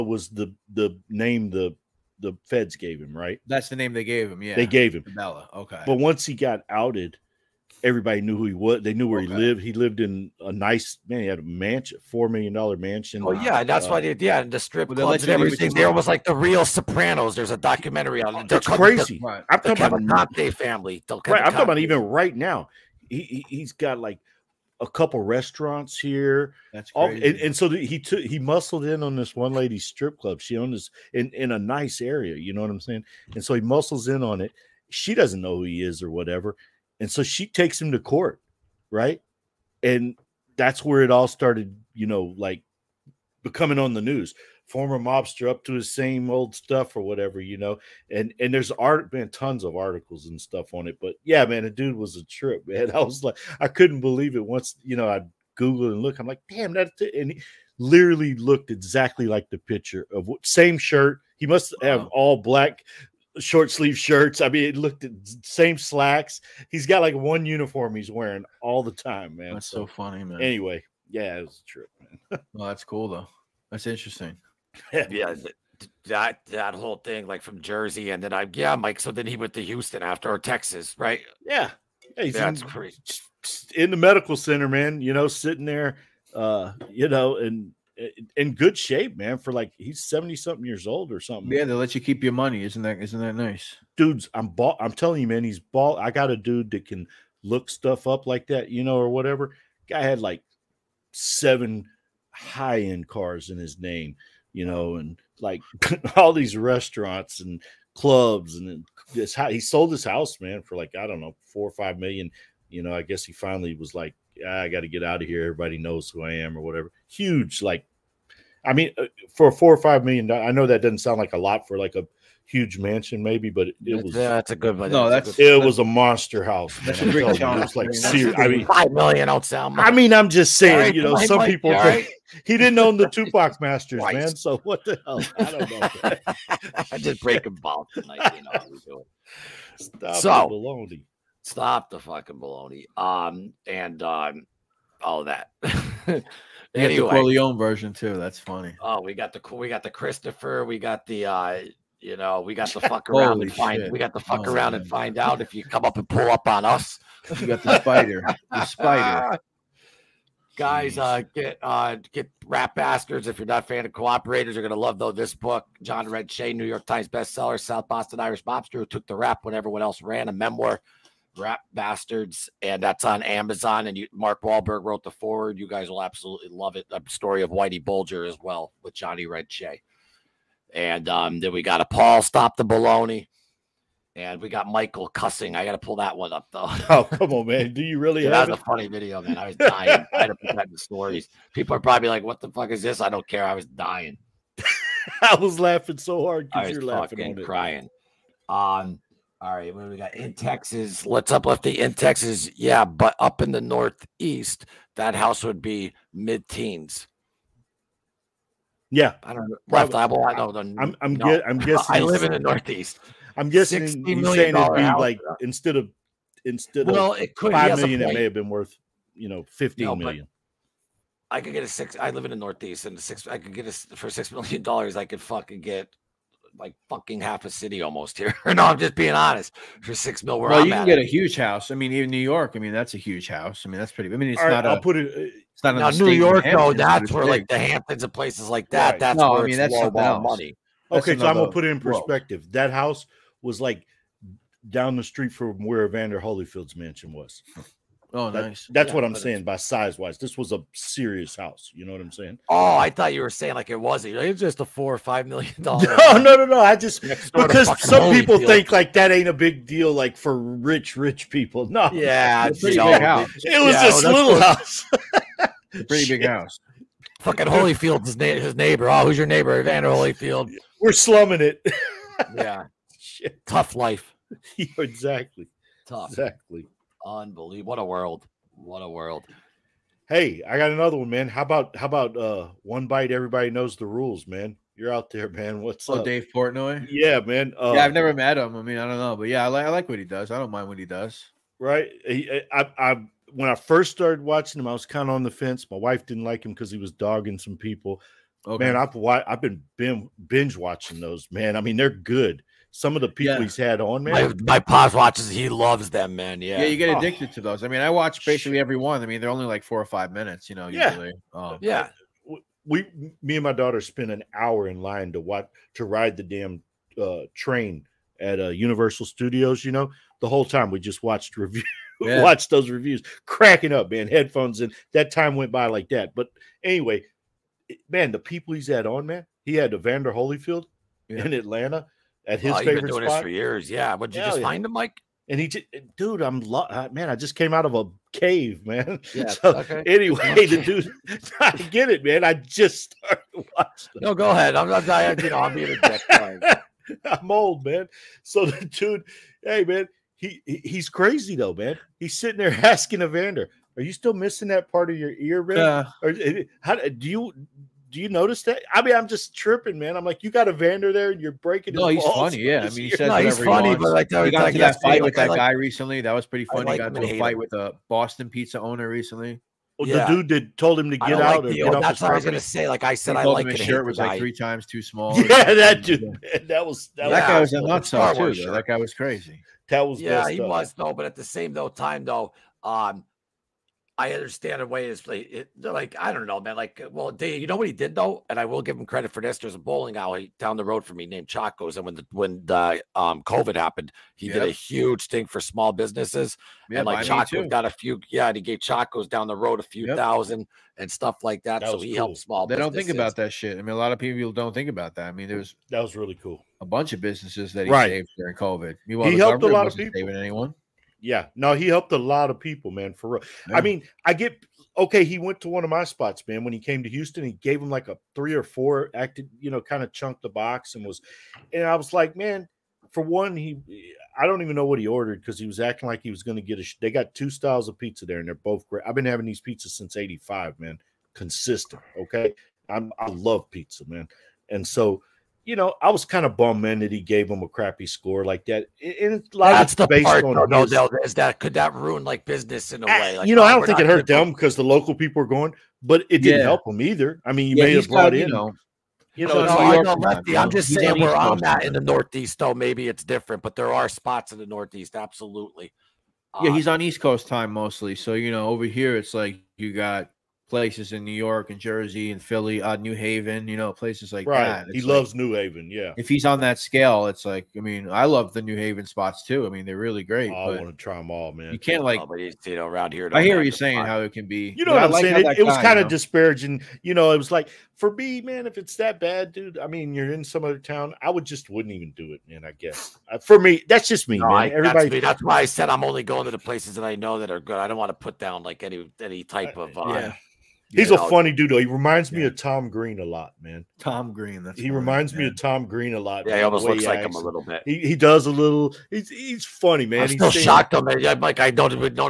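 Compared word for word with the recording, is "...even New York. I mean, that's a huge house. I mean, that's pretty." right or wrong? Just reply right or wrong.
right.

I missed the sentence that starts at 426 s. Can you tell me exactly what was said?
They got two styles of pizza there, and they're both great.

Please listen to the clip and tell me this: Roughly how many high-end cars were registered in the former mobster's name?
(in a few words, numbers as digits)
7.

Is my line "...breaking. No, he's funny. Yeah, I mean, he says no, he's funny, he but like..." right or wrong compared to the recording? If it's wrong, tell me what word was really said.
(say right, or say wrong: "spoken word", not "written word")
right.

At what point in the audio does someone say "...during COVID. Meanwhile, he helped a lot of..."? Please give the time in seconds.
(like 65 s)
408 s.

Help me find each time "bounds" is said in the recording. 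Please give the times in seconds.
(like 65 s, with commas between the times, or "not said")
not said.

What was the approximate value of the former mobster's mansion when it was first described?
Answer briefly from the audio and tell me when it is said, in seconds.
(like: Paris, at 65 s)
$4 million, at 12 s.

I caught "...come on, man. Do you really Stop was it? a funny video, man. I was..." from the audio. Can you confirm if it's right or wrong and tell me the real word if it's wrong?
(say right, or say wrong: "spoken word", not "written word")
wrong: "That", not "Stop".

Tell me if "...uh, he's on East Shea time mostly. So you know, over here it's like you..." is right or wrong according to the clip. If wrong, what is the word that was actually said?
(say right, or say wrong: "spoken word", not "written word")
wrong: "Coast", not "Shea".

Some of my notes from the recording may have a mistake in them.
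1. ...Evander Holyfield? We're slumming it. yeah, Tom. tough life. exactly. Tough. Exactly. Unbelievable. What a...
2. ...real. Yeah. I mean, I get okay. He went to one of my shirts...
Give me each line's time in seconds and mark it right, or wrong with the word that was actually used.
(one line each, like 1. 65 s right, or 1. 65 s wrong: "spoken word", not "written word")
1. 269 s wrong: "Shit", not "Tom"
2. 413 s wrong: "spots", not "shirts".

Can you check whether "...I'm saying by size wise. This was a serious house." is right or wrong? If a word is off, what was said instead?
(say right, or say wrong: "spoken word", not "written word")
right.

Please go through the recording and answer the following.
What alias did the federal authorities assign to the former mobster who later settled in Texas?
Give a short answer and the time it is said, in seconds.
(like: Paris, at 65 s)
Cabela, at 5 s.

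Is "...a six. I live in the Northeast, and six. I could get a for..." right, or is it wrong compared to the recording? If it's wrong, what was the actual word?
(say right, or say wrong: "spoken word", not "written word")
right.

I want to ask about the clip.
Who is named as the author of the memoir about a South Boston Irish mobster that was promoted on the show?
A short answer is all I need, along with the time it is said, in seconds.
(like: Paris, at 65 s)
John Red Shea, at 165 s.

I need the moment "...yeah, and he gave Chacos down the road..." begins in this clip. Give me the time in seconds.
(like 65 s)
398 s.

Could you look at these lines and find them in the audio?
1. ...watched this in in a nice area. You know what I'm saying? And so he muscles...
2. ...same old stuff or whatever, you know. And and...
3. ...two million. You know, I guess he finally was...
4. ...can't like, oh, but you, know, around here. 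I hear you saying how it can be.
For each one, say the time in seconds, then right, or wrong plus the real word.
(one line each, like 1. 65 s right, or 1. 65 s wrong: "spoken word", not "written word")
1. 30 s wrong: "owned", not "watched"
2. 45 s right
3. 111 s wrong: "five", not "two"
4. 471 s right.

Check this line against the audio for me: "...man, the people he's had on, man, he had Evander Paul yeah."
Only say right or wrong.
wrong.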